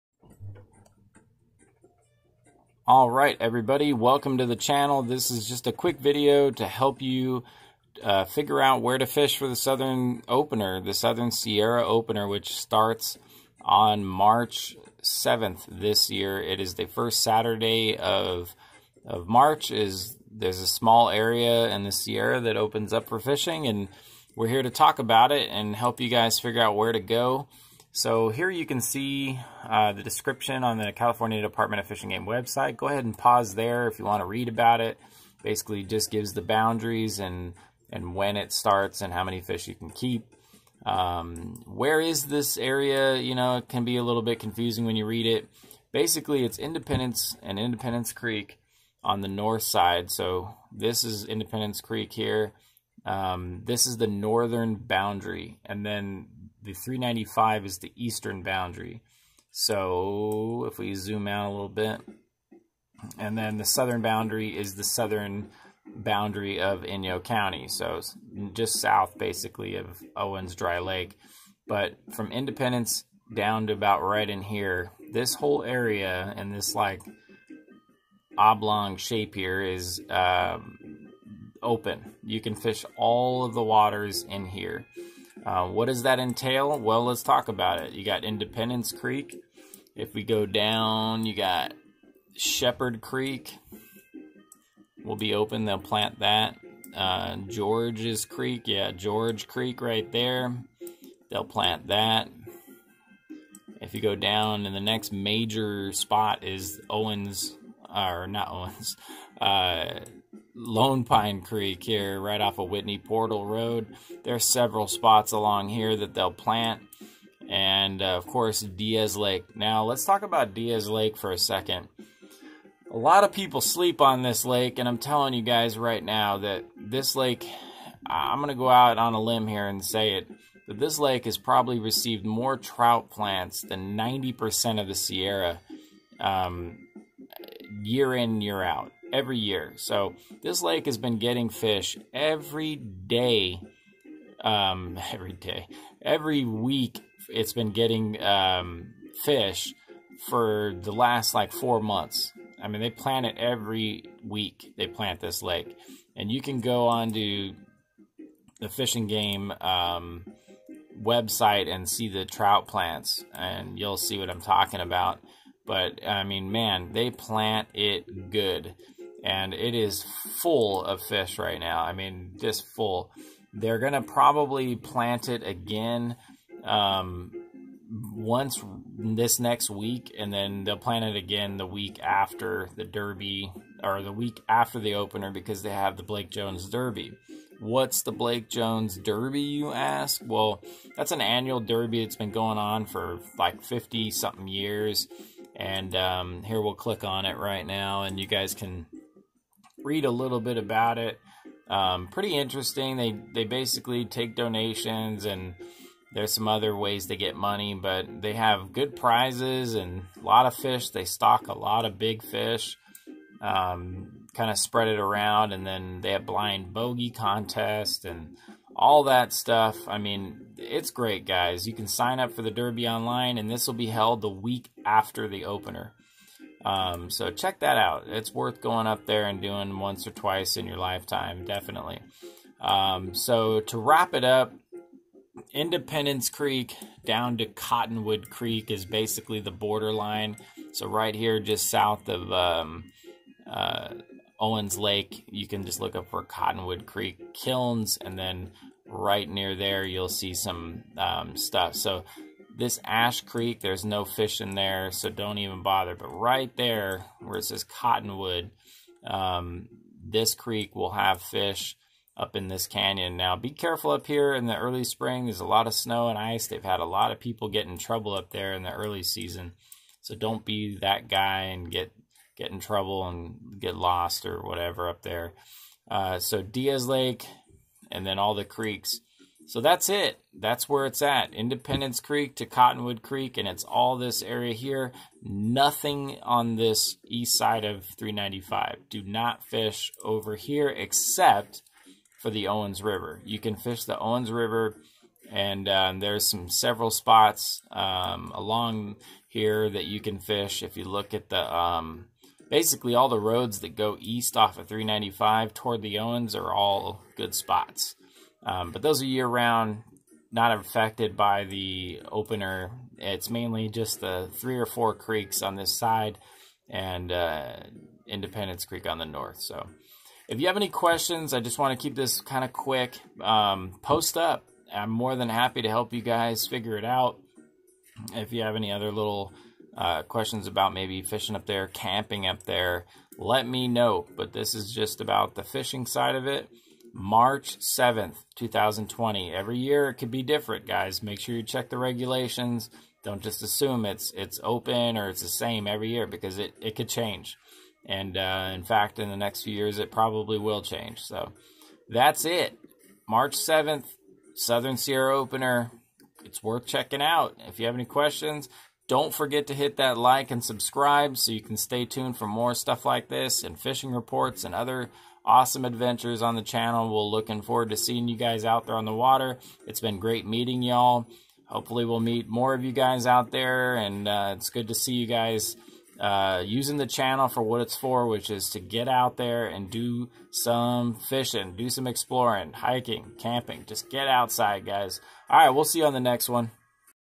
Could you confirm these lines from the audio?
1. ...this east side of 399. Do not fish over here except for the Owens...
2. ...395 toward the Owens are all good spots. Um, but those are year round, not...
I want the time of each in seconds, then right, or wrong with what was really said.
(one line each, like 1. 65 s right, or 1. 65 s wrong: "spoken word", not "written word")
1. 286 s wrong: "395", not "399"
2. 304 s right.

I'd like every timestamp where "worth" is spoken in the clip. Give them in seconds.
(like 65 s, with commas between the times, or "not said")
228 s, 356 s.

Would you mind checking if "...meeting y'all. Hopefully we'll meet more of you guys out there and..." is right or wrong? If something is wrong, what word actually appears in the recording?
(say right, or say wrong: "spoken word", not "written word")
right.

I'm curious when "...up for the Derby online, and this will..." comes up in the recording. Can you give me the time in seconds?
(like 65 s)
222 s.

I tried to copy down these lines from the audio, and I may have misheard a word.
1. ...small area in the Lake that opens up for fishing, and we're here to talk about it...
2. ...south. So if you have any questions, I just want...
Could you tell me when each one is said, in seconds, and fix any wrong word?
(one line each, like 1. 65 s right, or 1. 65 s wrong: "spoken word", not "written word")
1. 20 s wrong: "Sierra", not "Lake"
2. 319 s wrong: "north", not "south".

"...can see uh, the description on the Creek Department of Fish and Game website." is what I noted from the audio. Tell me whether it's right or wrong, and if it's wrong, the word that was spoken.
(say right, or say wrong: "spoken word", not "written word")
wrong: "California", not "Creek".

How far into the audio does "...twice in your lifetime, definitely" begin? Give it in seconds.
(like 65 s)
230 s.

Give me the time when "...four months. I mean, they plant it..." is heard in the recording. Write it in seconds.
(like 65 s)
151 s.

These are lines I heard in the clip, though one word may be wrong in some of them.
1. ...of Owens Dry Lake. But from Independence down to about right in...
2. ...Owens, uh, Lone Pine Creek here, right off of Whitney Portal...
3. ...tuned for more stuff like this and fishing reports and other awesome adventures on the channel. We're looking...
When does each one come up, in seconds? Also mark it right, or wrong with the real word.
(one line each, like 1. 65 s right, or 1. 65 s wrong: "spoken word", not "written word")
1. 69 s right
2. 108 s right
3. 361 s right.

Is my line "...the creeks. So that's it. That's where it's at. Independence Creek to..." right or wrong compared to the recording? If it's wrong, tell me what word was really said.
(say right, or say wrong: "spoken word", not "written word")
right.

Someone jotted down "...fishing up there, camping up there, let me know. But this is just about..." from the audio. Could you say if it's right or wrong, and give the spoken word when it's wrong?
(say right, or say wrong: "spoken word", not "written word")
right.